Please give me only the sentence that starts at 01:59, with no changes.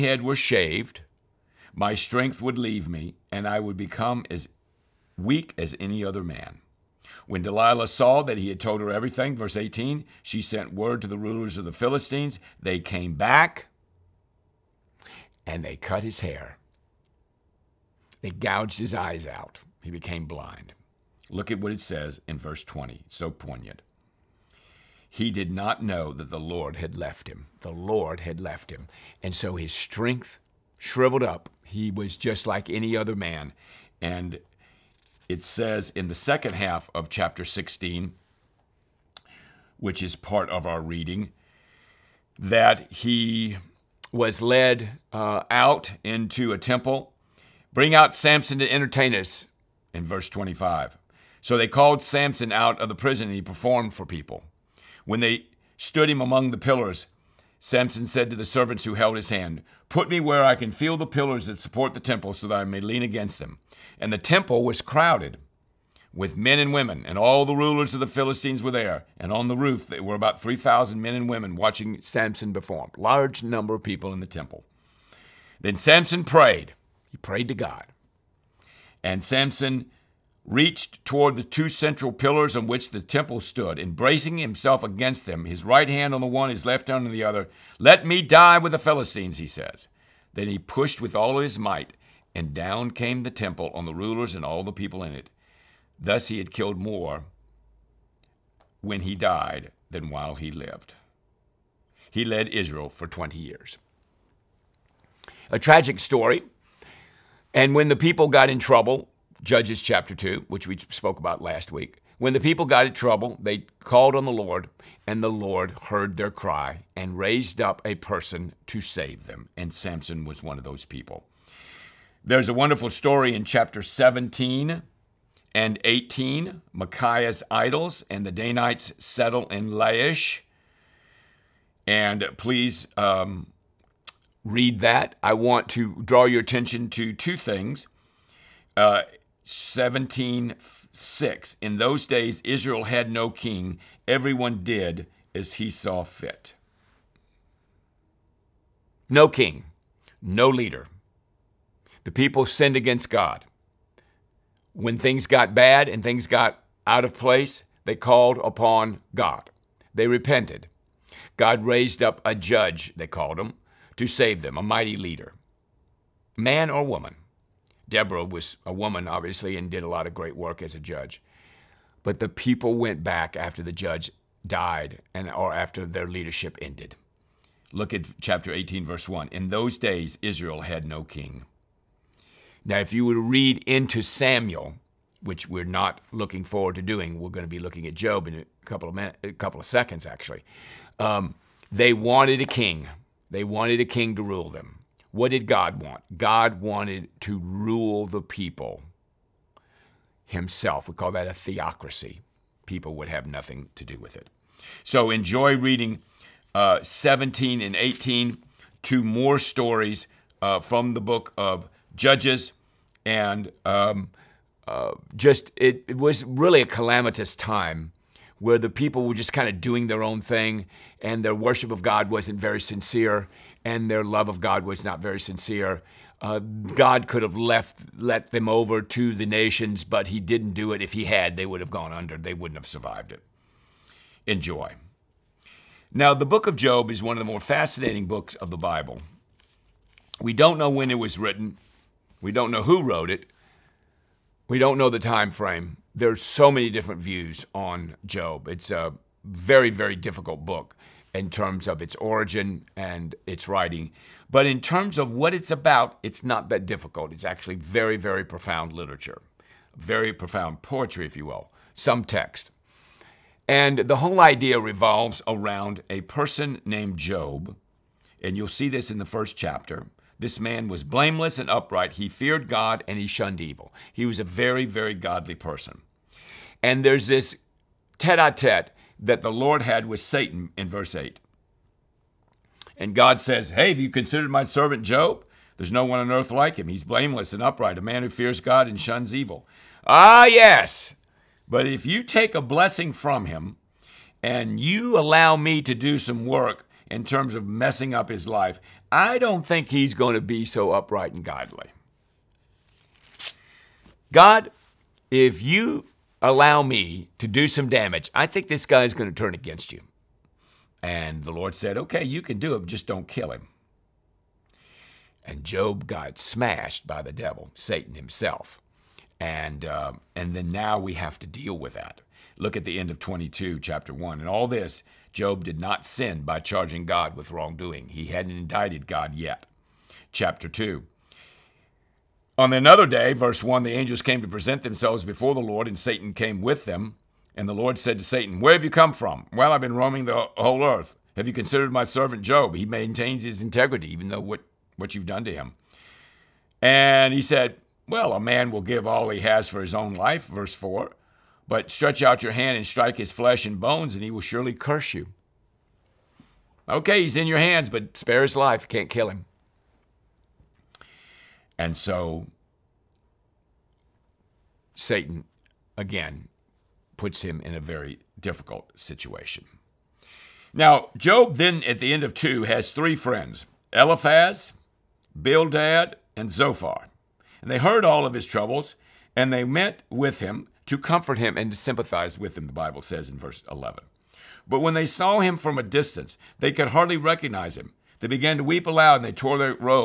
And Samson was one of those people.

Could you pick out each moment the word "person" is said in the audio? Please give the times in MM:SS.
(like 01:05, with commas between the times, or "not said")
01:57, 04:26, 04:35.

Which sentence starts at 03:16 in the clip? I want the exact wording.
God wanted to rule the people himself.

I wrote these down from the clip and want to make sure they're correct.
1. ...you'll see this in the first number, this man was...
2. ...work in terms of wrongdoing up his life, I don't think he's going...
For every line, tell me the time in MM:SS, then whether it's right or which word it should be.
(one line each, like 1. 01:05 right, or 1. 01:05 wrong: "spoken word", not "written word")
1. 04:28 wrong: "chapter", not "number"
2. 04:56 wrong: "messing", not "wrongdoing".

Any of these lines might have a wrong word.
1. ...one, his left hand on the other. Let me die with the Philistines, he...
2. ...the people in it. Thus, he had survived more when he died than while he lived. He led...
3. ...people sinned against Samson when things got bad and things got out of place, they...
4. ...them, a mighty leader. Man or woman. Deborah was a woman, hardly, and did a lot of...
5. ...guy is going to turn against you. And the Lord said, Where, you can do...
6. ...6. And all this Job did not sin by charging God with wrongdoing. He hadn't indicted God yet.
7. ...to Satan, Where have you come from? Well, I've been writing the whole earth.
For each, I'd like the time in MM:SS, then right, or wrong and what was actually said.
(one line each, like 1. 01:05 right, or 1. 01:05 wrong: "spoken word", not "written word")
1. 01:26 right
2. 01:34 wrong: "killed", not "survived"
3. 02:32 wrong: "God", not "Samson"
4. 02:44 wrong: "obviously", not "hardly"
5. 05:08 wrong: "Okay", not "Where"
6. 05:23 wrong: "1", not "6"
7. 05:37 wrong: "roaming", not "writing".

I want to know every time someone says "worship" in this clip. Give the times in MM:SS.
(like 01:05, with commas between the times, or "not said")
03:41.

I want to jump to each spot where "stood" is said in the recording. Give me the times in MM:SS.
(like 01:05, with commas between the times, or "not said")
00:55, 01:23.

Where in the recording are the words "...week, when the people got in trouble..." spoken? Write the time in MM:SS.
01:51.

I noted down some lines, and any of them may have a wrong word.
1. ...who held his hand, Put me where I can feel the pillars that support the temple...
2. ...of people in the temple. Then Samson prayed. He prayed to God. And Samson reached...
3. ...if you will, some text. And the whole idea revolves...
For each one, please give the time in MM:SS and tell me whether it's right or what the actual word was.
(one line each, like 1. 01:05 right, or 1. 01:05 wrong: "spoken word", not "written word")
1. 00:58 right
2. 01:13 right
3. 04:21 right.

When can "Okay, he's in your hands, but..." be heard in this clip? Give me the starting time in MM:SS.
05:56.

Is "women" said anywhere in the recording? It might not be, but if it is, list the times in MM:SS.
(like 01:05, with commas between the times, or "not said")
01:06, 01:11.